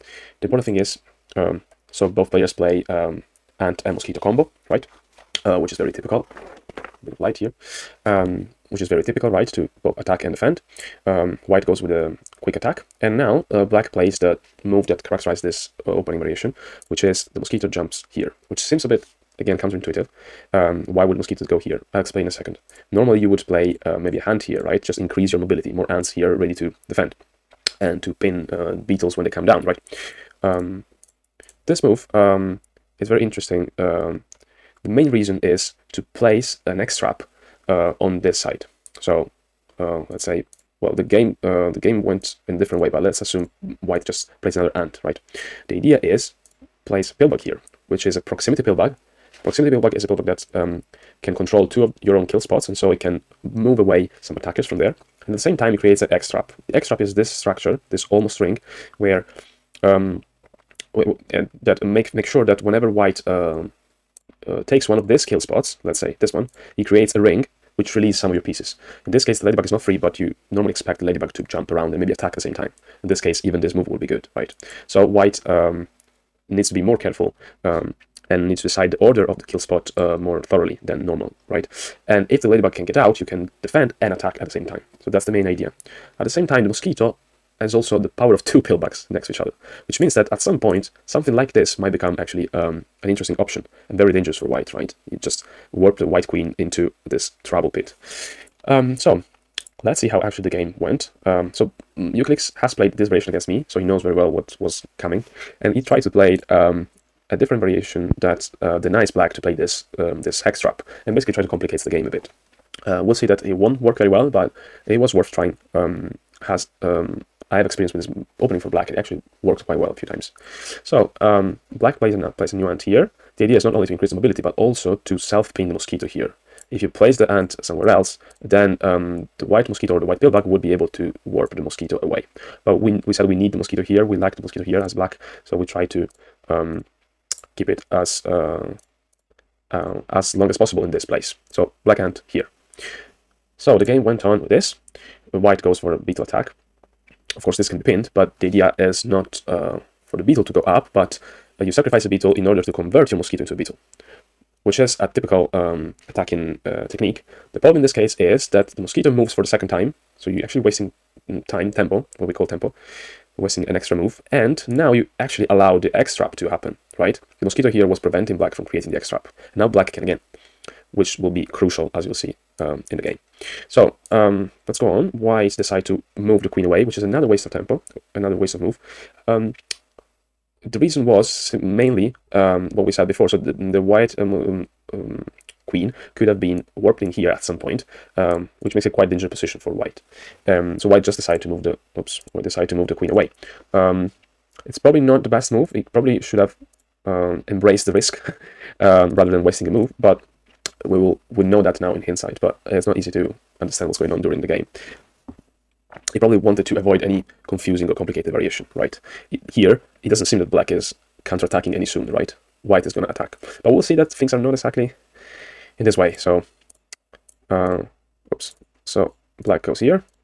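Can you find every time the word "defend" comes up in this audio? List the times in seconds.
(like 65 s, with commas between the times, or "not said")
10 s, 26 s, 83 s.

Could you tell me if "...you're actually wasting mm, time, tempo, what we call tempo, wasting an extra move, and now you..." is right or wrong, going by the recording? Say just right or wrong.
right.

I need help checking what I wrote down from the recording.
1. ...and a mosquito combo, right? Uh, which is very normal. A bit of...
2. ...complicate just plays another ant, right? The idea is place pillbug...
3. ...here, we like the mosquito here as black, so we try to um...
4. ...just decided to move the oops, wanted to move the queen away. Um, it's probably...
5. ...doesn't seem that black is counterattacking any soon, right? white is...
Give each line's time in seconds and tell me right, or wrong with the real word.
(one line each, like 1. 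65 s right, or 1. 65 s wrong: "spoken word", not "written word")
1. 3 s wrong: "typical", not "normal"
2. 43 s wrong: "white", not "complicate"
3. 133 s right
4. 191 s wrong: "decided", not "wanted"
5. 210 s right.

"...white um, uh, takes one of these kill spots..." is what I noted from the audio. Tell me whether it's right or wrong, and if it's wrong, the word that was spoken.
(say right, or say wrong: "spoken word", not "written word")
right.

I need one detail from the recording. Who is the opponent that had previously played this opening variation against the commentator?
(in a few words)
Eucalyx.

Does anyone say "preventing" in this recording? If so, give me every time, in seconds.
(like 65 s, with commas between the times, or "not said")
167 s.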